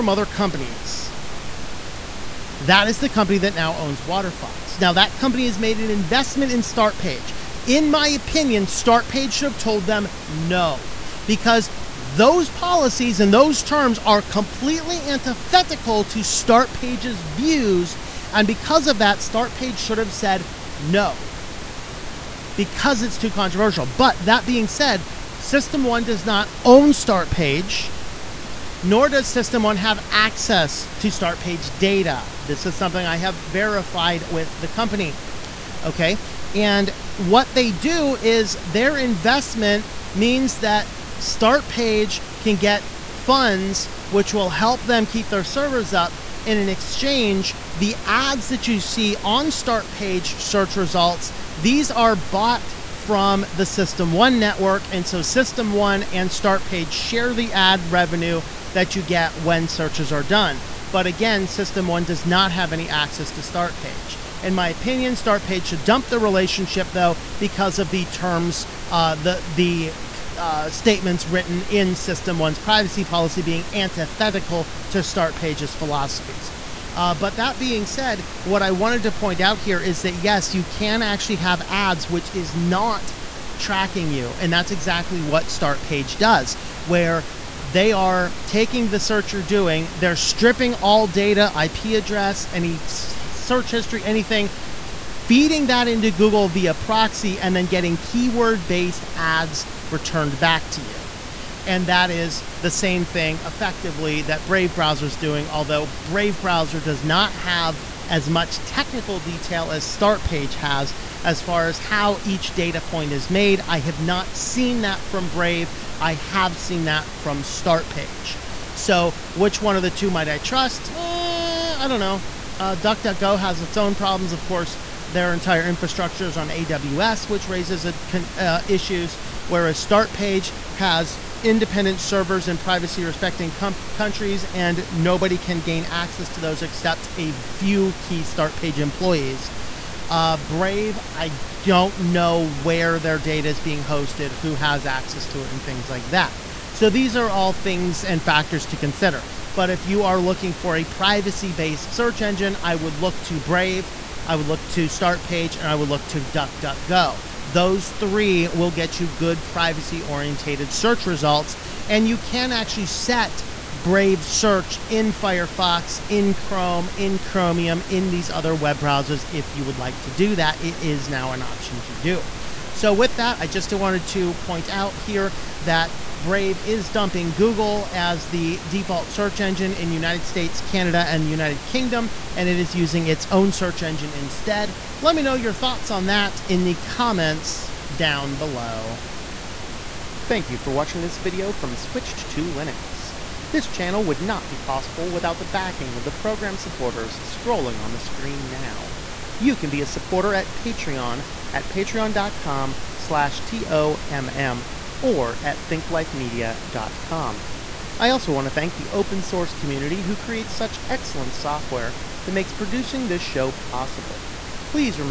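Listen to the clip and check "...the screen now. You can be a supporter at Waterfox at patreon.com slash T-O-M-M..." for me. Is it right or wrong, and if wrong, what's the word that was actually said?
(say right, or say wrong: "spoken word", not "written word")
wrong: "Patreon", not "Waterfox".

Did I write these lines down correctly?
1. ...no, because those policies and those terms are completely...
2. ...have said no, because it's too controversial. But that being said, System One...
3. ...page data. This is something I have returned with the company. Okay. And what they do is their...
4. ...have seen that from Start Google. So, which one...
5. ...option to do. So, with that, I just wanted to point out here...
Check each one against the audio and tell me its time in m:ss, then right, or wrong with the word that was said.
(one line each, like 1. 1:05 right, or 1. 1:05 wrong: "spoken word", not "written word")
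1. 0:10 right
2. 0:19 right
3. 0:31 wrong: "verified", not "returned"
4. 1:56 wrong: "Page", not "Google"
5. 2:51 right.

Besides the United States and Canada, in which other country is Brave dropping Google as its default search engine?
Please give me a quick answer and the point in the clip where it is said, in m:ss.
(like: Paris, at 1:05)
United Kingdom, at 3:01.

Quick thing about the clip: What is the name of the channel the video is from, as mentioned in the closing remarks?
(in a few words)
Switched to Linux.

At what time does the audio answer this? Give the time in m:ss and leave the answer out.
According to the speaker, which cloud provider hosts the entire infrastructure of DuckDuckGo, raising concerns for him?
2:06.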